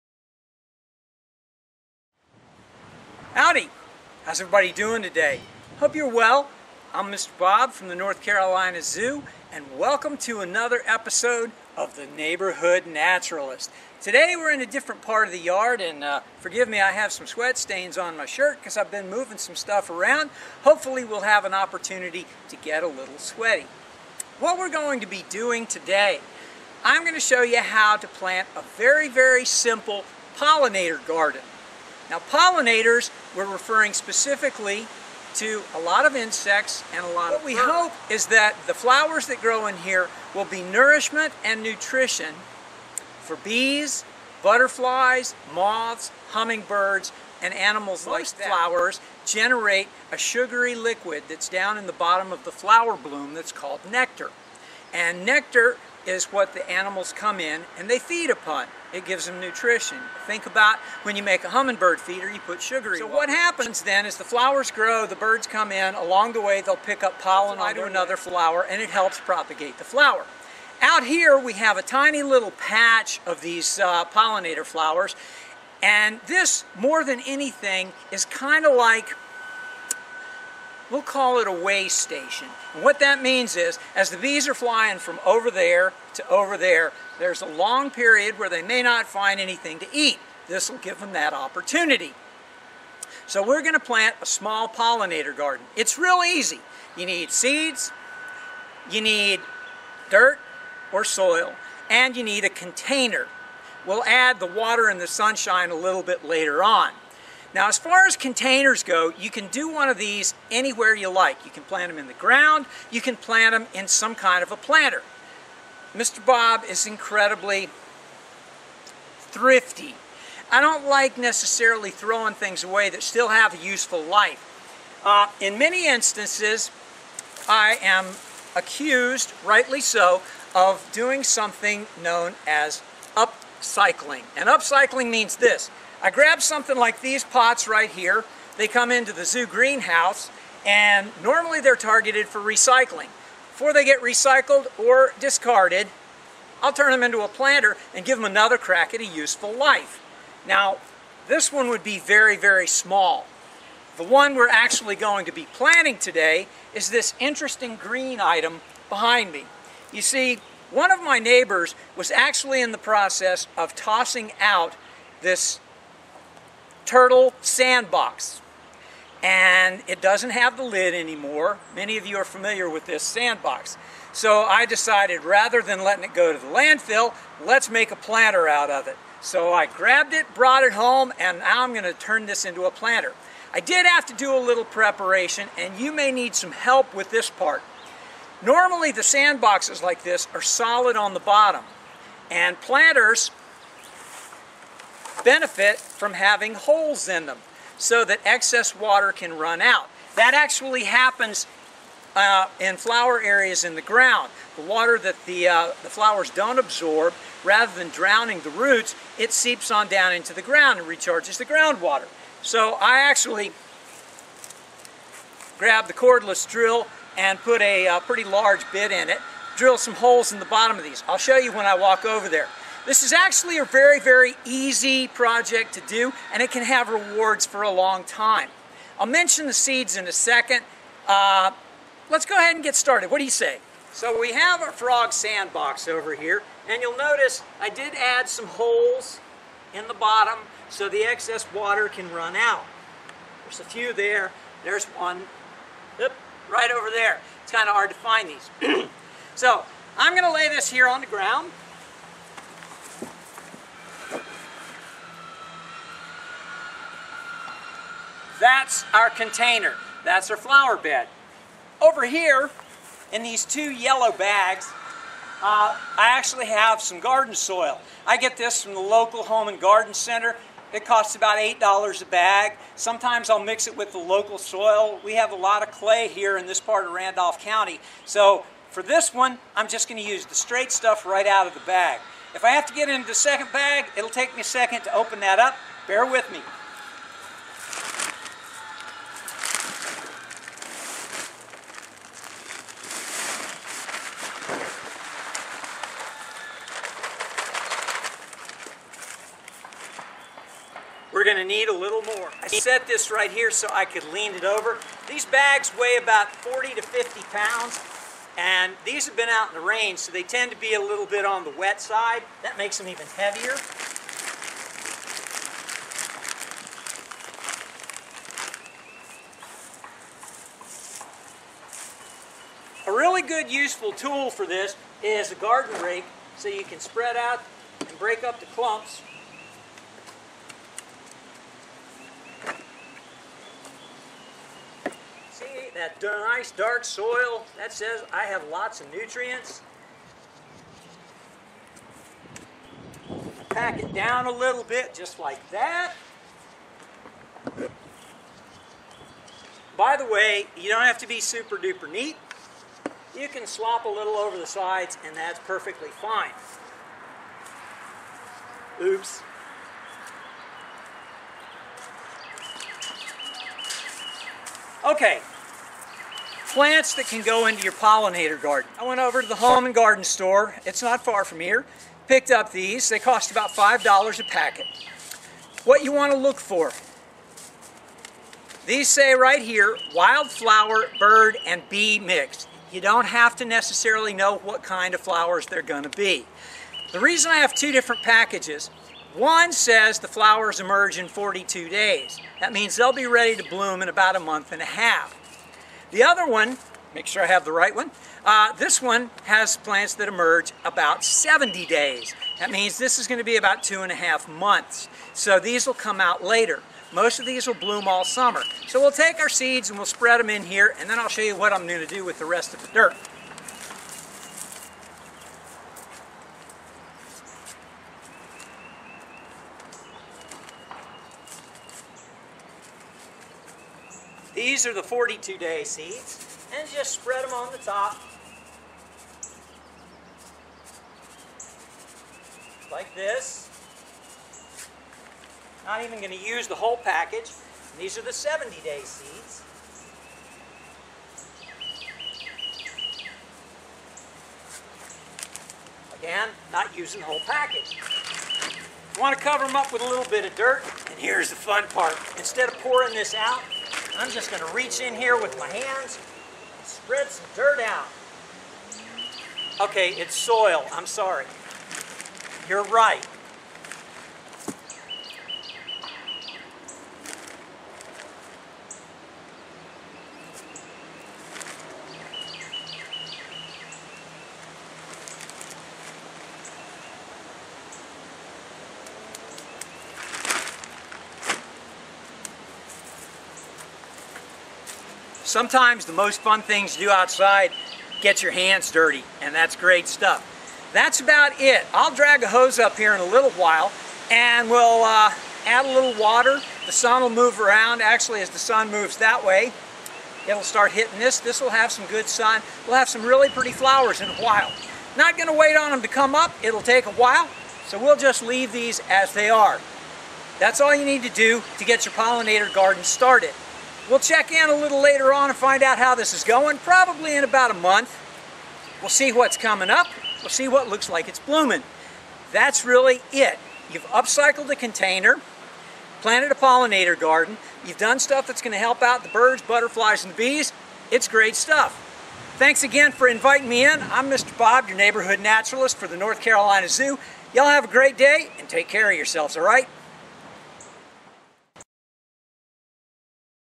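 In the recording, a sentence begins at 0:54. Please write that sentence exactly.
And nectar is what the animals come in and they feed upon.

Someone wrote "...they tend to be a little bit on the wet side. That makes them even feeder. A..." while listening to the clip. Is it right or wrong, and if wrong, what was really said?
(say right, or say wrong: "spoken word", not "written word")
wrong: "heavier", not "feeder".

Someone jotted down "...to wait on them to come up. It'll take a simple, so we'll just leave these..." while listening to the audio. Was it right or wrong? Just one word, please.
wrong.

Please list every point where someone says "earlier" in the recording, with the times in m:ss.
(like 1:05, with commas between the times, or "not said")
not said.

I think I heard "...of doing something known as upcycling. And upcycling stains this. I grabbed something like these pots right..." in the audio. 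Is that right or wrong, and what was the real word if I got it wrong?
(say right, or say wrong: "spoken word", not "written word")
wrong: "means", not "stains".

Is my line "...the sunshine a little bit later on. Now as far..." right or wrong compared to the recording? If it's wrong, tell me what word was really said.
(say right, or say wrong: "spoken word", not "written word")
right.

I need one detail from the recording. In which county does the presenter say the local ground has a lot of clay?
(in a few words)
Randolph County.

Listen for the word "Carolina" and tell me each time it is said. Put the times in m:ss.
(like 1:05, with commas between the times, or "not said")
0:08, 8:56.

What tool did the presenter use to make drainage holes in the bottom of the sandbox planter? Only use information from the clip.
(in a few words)
cordless drill.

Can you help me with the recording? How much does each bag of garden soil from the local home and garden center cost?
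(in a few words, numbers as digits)
$8.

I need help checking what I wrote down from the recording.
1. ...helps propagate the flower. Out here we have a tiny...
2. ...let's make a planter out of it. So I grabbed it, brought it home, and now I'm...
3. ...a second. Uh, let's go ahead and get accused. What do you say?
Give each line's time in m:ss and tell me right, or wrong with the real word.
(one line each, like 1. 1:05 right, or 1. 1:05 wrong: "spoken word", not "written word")
1. 1:08 right
2. 2:57 right
3. 3:50 wrong: "started", not "accused".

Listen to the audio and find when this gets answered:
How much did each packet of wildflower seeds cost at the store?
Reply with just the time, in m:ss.
6:13.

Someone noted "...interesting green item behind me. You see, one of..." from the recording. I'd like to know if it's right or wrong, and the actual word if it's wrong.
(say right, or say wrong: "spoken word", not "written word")
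right.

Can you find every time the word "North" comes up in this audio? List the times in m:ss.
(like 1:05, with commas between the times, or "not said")
0:07, 8:55.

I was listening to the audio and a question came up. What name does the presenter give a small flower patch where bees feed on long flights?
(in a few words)
way station.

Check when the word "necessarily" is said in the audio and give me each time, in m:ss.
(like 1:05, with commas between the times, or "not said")
2:01, 6:23.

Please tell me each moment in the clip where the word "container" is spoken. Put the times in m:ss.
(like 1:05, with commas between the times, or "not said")
1:42, 1:48, 4:19, 8:44.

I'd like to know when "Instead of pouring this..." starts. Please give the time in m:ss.
7:32.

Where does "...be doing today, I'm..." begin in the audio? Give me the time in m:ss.
0:25.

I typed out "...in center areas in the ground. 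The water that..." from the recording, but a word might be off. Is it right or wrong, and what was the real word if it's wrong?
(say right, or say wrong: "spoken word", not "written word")
wrong: "flower", not "center".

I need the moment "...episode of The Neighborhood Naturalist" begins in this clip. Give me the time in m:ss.
0:10.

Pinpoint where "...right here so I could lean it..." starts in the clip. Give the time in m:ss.
5:03.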